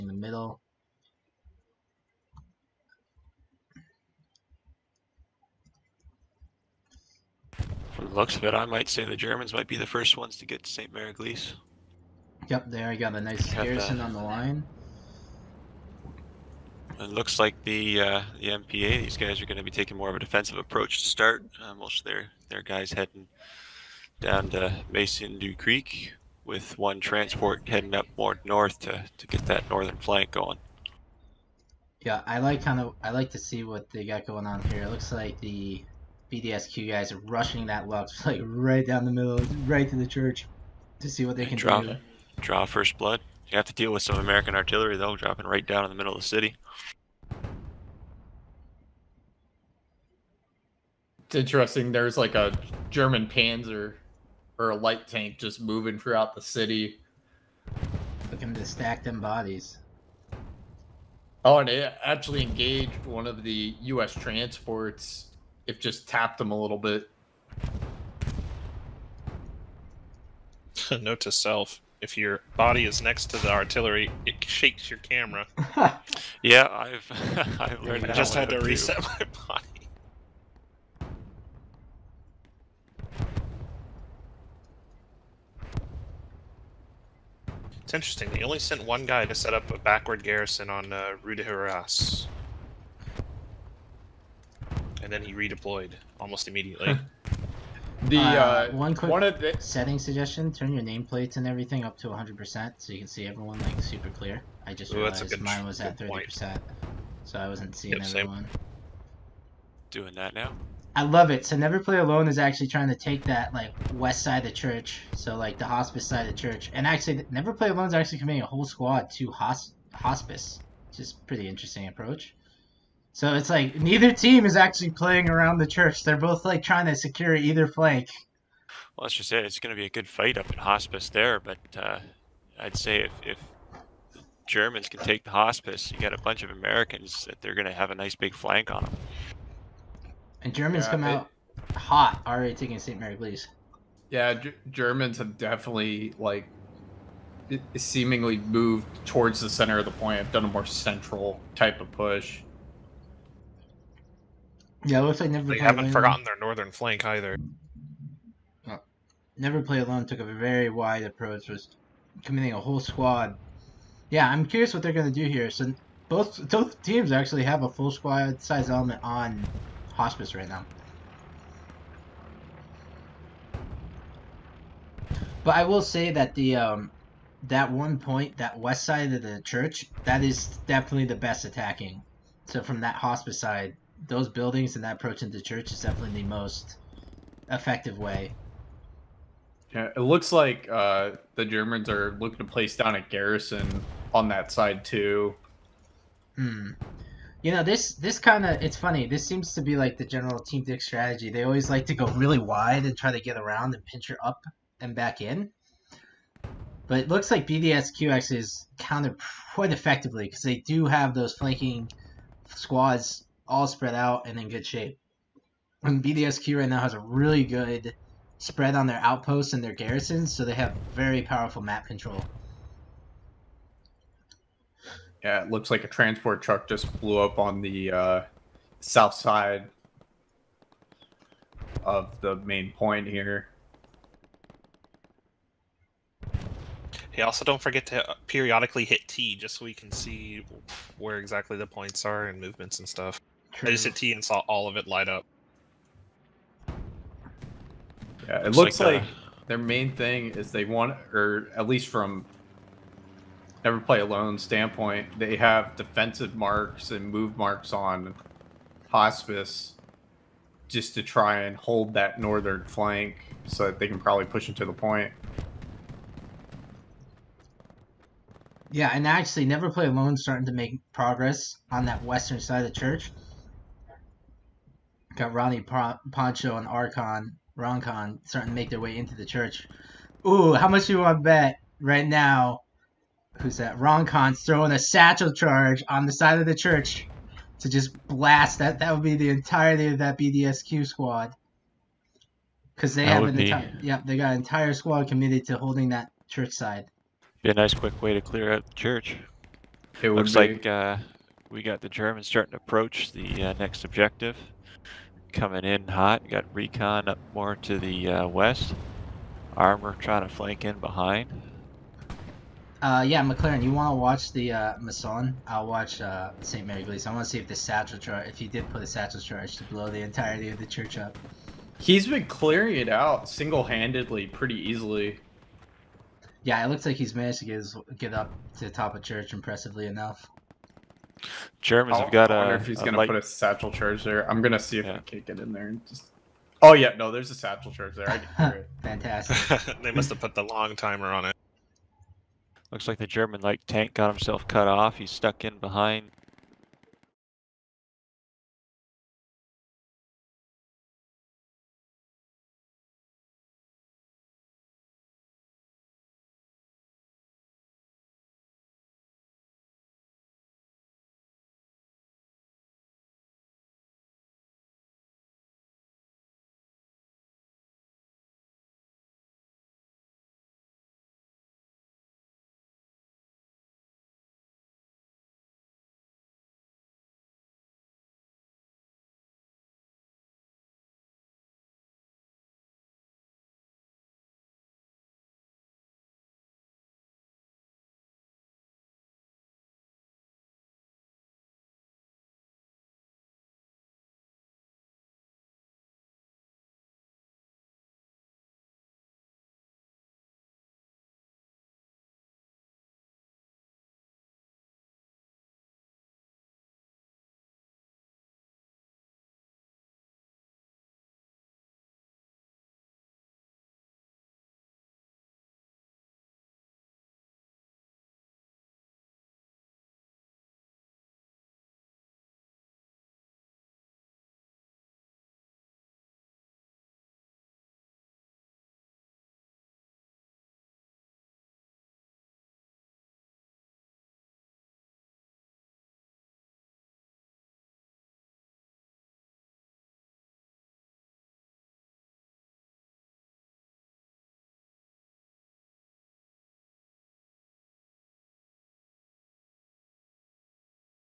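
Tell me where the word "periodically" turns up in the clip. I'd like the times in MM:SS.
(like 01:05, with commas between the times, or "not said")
03:58.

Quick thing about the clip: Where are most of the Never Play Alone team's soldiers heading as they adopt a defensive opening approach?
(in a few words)
Maison du Crique.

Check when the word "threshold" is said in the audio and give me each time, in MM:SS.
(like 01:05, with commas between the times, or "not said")
not said.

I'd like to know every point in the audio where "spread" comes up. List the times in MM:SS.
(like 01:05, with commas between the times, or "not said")
03:33, 03:38.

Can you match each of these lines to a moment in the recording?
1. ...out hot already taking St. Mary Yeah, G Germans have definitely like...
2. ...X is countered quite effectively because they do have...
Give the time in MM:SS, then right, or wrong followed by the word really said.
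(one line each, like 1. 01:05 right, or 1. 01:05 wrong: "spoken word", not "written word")
1. 02:21 right
2. 03:28 right.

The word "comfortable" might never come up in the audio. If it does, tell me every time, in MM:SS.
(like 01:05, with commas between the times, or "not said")
not said.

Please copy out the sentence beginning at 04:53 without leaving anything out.
yeah, they got an entire squad committed to holding that church side.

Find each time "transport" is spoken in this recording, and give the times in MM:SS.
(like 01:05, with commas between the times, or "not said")
00:27, 01:04, 03:45.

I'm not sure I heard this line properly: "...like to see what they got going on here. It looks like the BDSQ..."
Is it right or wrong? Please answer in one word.
right.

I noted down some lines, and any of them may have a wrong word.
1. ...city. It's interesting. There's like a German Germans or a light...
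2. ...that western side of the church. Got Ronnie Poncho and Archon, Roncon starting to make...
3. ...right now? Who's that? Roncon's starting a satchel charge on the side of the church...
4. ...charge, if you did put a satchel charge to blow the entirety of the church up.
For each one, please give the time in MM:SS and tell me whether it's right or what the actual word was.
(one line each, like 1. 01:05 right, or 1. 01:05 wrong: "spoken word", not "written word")
1. 00:46 wrong: "Panzer", not "Germans"
2. 04:31 right
3. 04:41 wrong: "throwing", not "starting"
4. 05:17 right.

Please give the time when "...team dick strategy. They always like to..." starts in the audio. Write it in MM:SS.
03:20.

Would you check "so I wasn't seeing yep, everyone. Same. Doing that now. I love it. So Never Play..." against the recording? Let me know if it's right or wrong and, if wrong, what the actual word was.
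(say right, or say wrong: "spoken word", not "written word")
right.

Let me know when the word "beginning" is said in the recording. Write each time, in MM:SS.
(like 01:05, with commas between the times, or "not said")
not said.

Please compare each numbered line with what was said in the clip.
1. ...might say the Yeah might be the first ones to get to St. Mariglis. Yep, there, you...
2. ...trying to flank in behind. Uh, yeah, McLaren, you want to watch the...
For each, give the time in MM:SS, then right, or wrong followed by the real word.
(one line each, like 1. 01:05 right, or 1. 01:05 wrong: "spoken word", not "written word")
1. 00:08 wrong: "Germans", not "Yeah"
2. 05:09 right.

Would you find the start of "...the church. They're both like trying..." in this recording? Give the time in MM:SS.
02:05.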